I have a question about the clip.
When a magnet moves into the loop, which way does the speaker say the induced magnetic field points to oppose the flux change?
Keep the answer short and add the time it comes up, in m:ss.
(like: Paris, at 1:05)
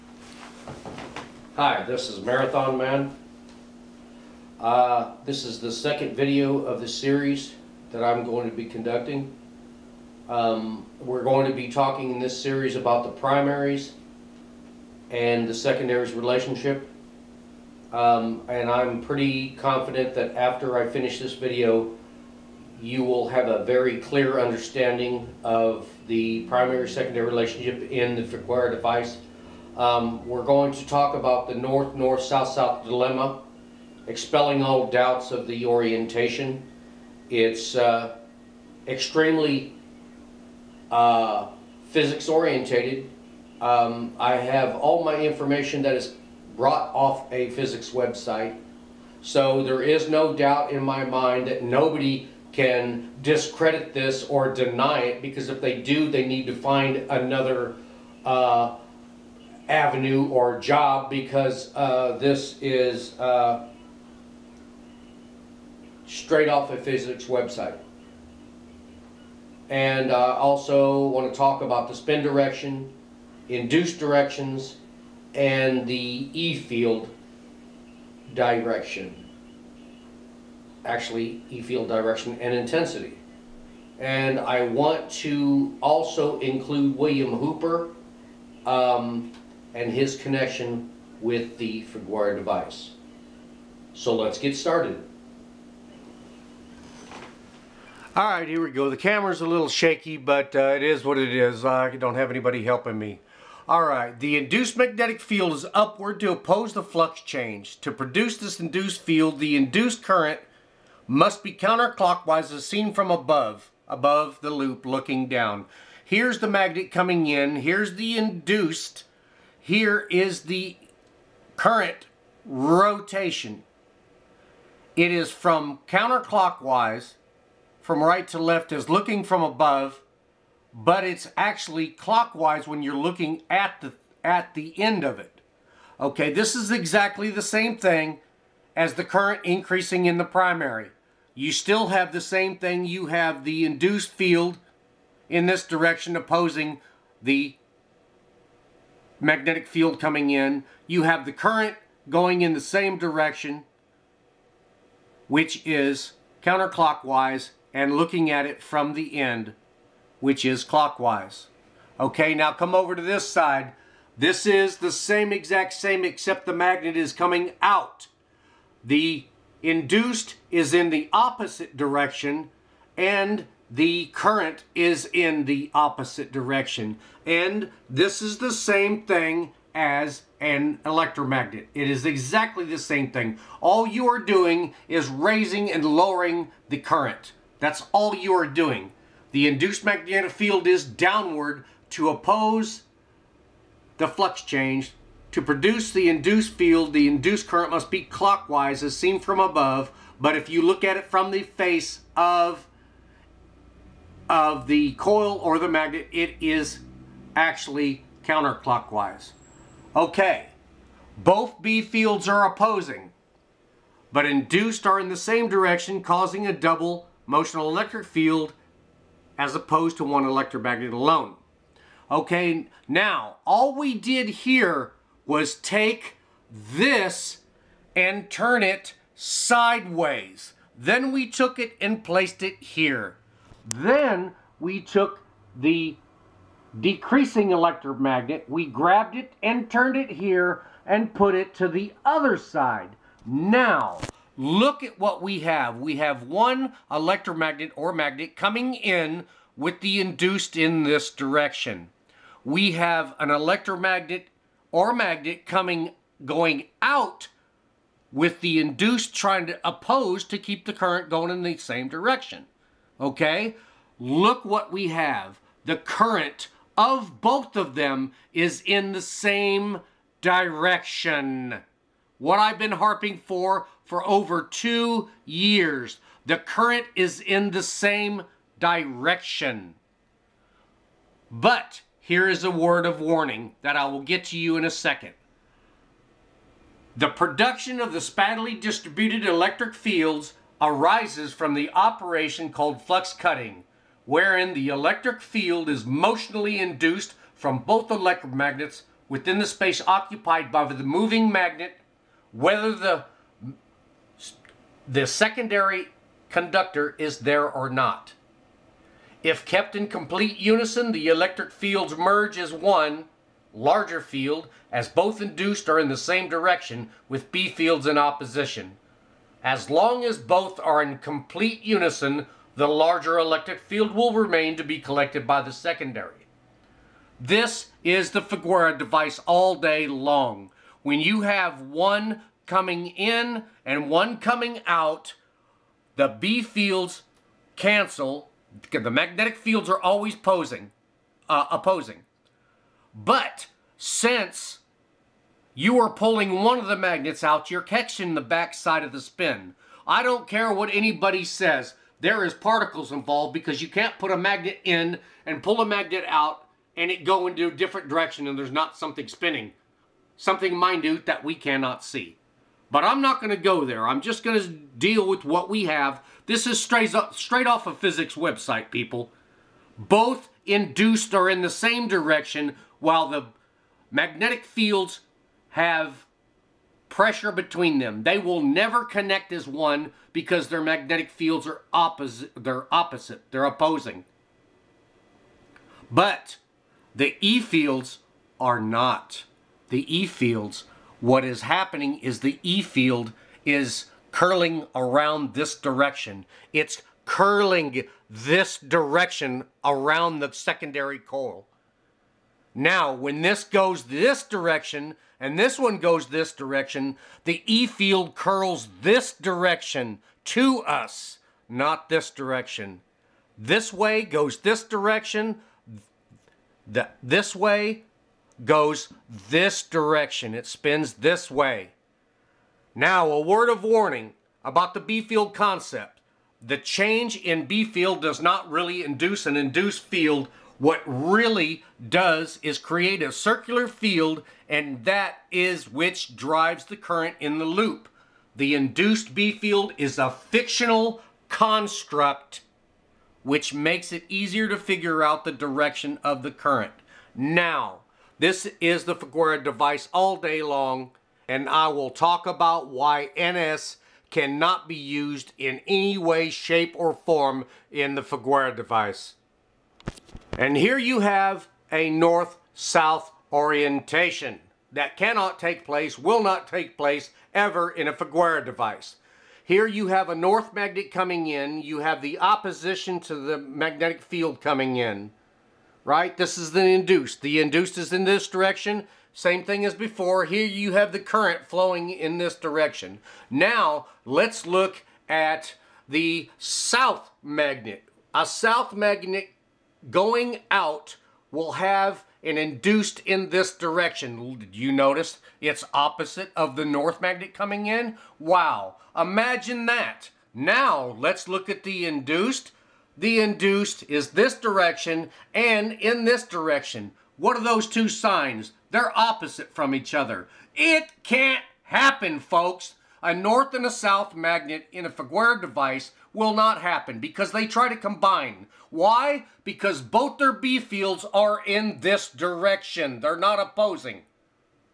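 Upward, at 1:45.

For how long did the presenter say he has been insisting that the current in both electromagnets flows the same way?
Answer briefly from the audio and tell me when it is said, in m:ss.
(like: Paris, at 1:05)
Over 2 years, at 4:34.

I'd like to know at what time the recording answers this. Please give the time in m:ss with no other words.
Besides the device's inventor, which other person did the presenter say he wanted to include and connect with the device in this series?
1:26.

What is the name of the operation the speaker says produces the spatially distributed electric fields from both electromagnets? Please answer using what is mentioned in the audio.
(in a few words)
Flux cutting.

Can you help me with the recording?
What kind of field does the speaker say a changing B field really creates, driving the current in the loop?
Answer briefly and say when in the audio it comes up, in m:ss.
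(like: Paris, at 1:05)
A circular field, at 7:13.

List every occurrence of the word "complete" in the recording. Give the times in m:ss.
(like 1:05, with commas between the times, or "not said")
5:09, 5:20.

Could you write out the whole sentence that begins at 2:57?
And this is the same thing as an electromagnet.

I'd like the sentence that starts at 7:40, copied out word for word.
And here you have a north-south orientation that cannot take place, will not take place ever in a Figuera device.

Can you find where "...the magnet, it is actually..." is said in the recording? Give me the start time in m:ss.
3:25.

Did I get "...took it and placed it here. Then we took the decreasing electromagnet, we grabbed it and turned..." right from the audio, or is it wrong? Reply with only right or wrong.
right.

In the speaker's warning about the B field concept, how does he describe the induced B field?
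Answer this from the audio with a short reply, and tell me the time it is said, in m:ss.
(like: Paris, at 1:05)
A fictional construct, at 7:20.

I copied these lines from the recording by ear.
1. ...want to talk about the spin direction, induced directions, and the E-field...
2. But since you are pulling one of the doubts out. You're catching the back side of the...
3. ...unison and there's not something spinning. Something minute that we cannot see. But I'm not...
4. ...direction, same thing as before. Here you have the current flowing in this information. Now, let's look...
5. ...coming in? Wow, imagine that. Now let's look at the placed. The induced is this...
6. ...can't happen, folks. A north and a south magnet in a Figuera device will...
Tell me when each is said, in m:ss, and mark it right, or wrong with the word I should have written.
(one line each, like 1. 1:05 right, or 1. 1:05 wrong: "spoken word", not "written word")
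1. 1:11 right
2. 5:42 wrong: "magnets", not "doubts"
3. 5:57 wrong: "direction", not "unison"
4. 7:58 wrong: "direction", not "information"
5. 8:17 wrong: "induced", not "placed"
6. 8:31 right.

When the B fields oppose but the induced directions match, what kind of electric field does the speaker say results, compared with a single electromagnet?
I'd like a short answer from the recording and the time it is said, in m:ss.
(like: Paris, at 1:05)
Double motional electric field, at 3:36.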